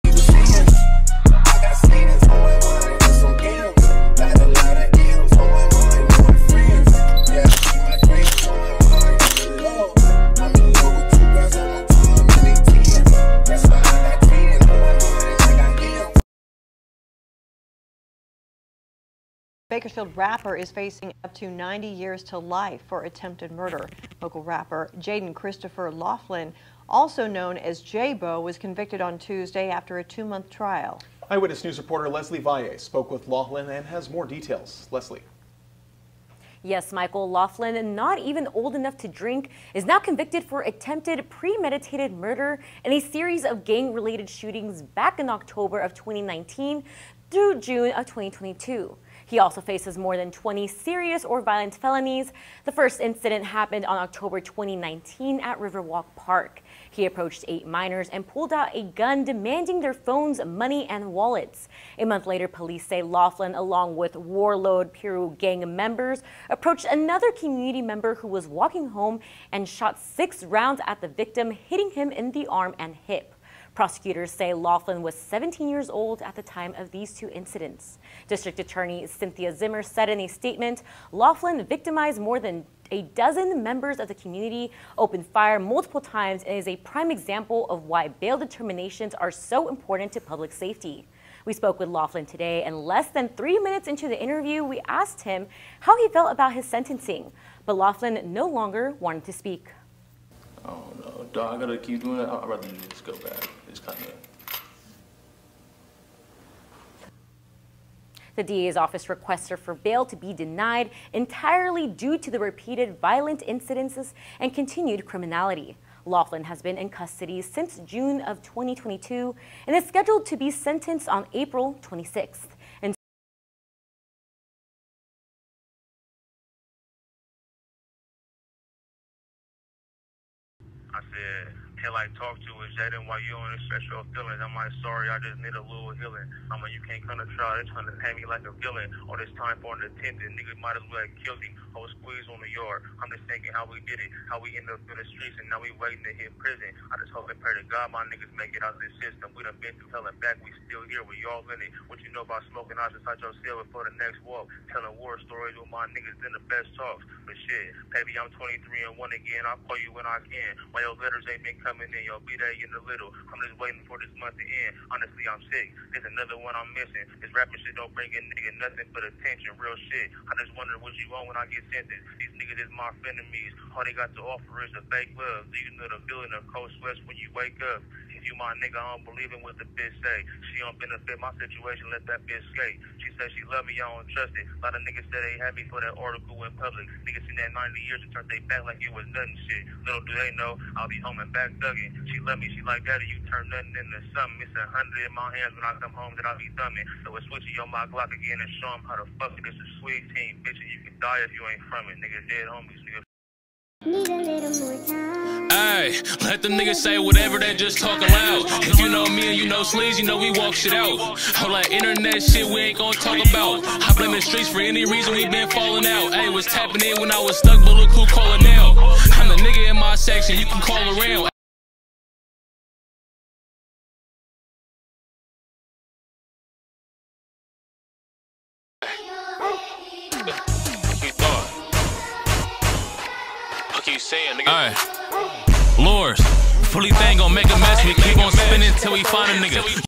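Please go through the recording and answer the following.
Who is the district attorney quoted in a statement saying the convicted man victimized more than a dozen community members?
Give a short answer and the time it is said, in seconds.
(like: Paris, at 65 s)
Cynthia Zimmer, at 79 s.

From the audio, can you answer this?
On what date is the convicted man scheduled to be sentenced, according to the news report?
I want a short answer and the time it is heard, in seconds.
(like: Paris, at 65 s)
April 26th, at 121 s.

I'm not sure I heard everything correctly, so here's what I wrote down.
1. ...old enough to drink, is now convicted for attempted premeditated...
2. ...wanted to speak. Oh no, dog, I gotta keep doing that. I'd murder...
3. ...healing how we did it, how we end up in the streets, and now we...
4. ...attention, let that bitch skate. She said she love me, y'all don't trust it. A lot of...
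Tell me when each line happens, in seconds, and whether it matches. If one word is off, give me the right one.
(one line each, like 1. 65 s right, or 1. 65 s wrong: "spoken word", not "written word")
1. 38 s right
2. 98 s wrong: "rather", not "murder"
3. 143 s wrong: "thinking", not "healing"
4. 181 s wrong: "situation", not "attention".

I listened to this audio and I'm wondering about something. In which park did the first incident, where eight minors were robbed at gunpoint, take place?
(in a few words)
Riverwalk Park.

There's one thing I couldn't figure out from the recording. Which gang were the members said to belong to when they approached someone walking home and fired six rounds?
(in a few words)
Warlord Piru.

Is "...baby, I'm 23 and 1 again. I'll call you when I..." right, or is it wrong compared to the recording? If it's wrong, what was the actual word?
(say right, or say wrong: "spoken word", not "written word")
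right.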